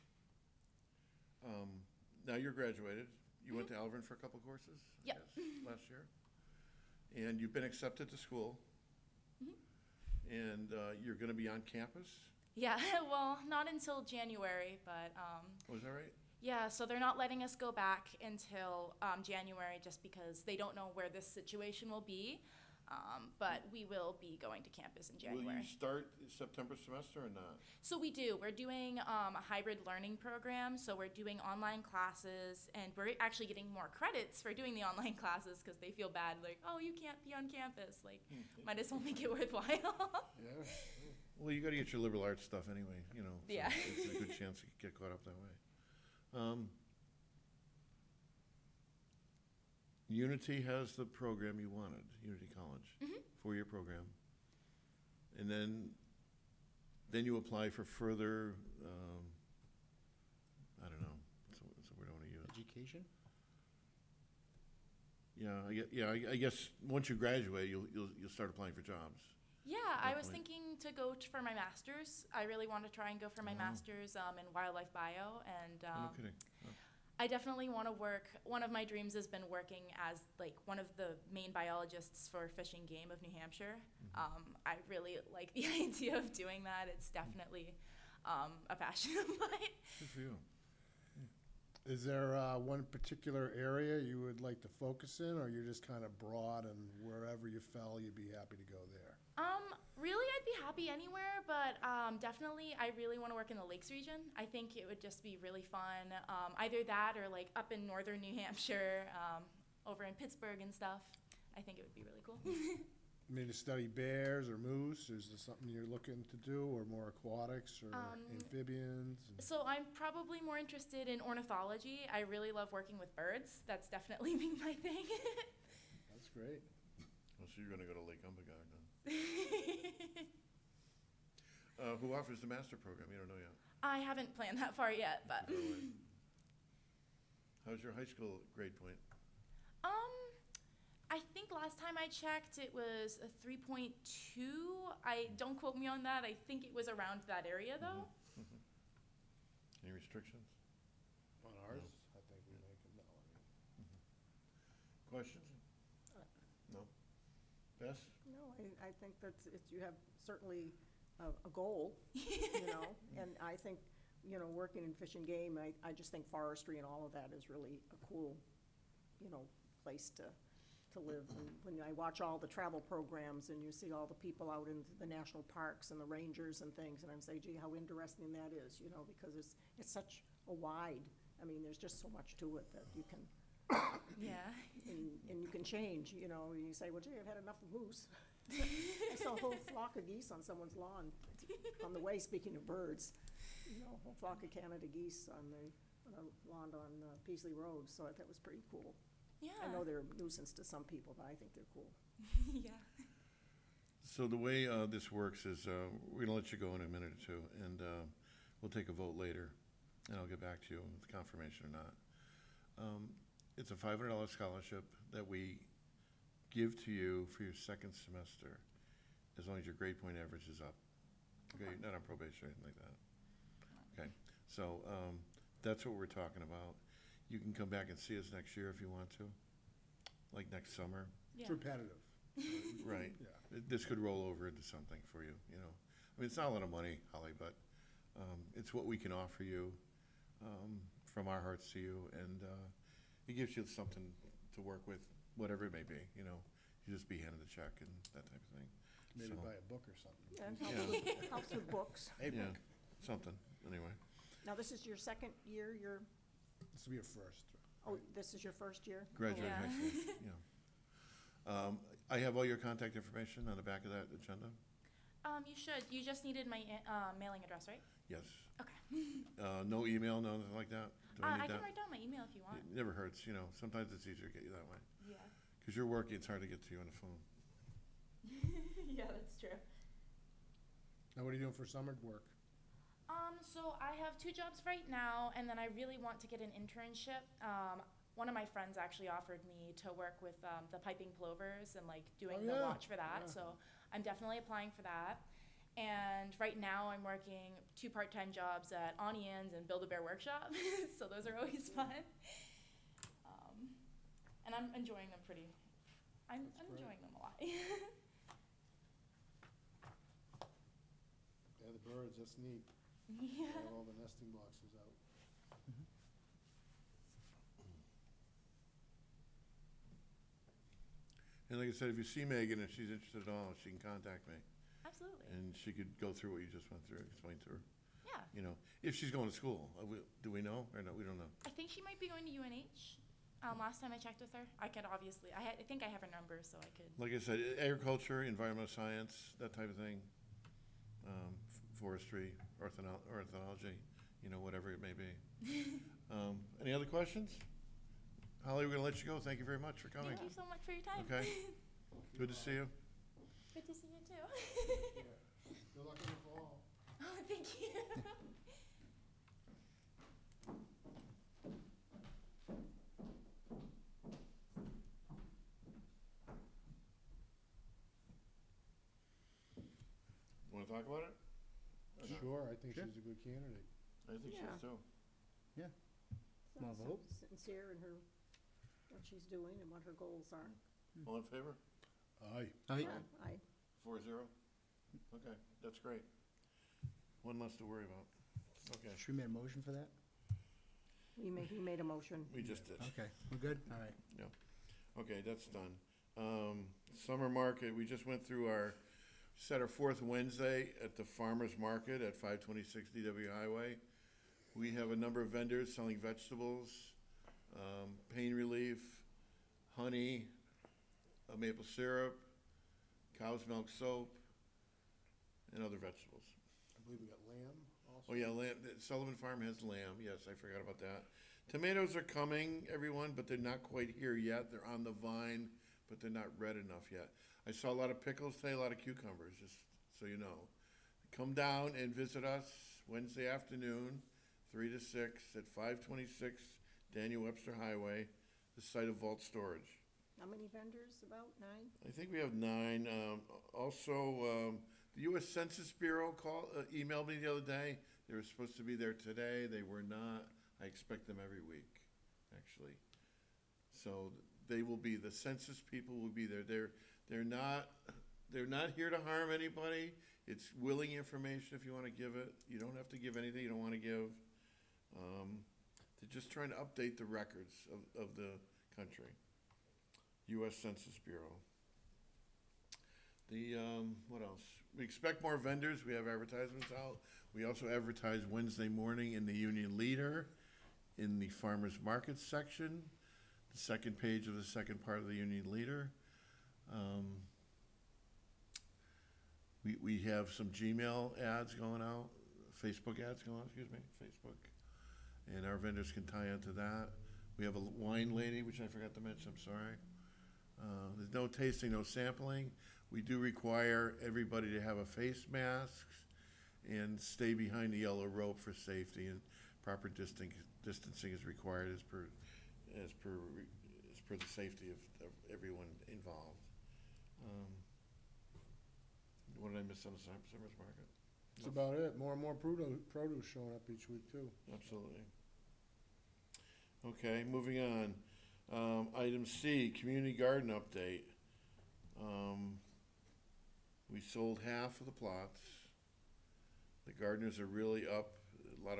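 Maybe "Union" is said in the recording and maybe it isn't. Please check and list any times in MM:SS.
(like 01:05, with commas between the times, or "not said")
07:59, 08:05.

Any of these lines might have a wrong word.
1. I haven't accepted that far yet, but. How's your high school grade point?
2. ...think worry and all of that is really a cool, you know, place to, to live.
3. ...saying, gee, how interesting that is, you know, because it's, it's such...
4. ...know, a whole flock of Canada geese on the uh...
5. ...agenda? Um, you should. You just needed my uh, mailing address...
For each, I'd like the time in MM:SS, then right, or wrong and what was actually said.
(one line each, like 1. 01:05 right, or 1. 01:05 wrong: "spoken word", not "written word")
1. 02:13 wrong: "planned", not "accepted"
2. 02:46 wrong: "forestry", not "worry"
3. 02:57 right
4. 03:13 right
5. 04:24 right.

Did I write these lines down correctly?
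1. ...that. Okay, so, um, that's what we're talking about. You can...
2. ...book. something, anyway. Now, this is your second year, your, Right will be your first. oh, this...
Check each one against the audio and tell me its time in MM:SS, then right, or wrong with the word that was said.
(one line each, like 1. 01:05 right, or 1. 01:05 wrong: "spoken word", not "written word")
1. 03:42 right
2. 04:12 wrong: "This", not "Right".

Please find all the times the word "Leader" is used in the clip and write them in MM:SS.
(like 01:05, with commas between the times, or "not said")
07:59, 08:05.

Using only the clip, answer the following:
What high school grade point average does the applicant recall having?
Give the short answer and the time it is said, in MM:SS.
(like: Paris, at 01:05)
3.2, at 02:23.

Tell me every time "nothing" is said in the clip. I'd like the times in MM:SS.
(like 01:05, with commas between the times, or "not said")
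04:30.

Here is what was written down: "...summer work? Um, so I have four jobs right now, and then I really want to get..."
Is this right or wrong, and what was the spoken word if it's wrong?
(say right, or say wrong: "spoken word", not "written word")
wrong: "two", not "four".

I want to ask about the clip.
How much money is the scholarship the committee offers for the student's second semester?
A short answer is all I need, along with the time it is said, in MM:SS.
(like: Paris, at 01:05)
$500, at 03:33.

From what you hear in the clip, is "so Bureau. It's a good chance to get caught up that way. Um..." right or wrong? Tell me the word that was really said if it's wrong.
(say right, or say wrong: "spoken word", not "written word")
wrong: "Yeah", not "Bureau".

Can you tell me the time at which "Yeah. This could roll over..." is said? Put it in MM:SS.
03:53.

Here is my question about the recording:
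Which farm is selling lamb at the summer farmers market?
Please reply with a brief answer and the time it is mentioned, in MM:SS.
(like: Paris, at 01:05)
Sullivan Farm, at 06:58.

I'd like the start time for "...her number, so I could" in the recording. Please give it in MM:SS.
05:36.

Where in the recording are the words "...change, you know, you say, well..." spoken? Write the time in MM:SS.
03:05.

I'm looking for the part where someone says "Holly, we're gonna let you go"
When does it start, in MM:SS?
05:48.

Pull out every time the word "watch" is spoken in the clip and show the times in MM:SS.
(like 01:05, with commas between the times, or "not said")
02:51, 04:52.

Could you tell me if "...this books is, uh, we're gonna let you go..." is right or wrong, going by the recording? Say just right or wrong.
wrong.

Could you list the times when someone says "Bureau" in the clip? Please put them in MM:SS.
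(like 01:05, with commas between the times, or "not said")
07:25, 07:51.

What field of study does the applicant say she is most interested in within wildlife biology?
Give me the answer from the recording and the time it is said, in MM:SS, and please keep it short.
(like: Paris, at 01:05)
Ornithology, at 02:01.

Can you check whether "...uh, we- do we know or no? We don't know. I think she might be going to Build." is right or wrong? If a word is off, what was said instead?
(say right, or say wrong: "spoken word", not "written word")
wrong: "UNH", not "Build".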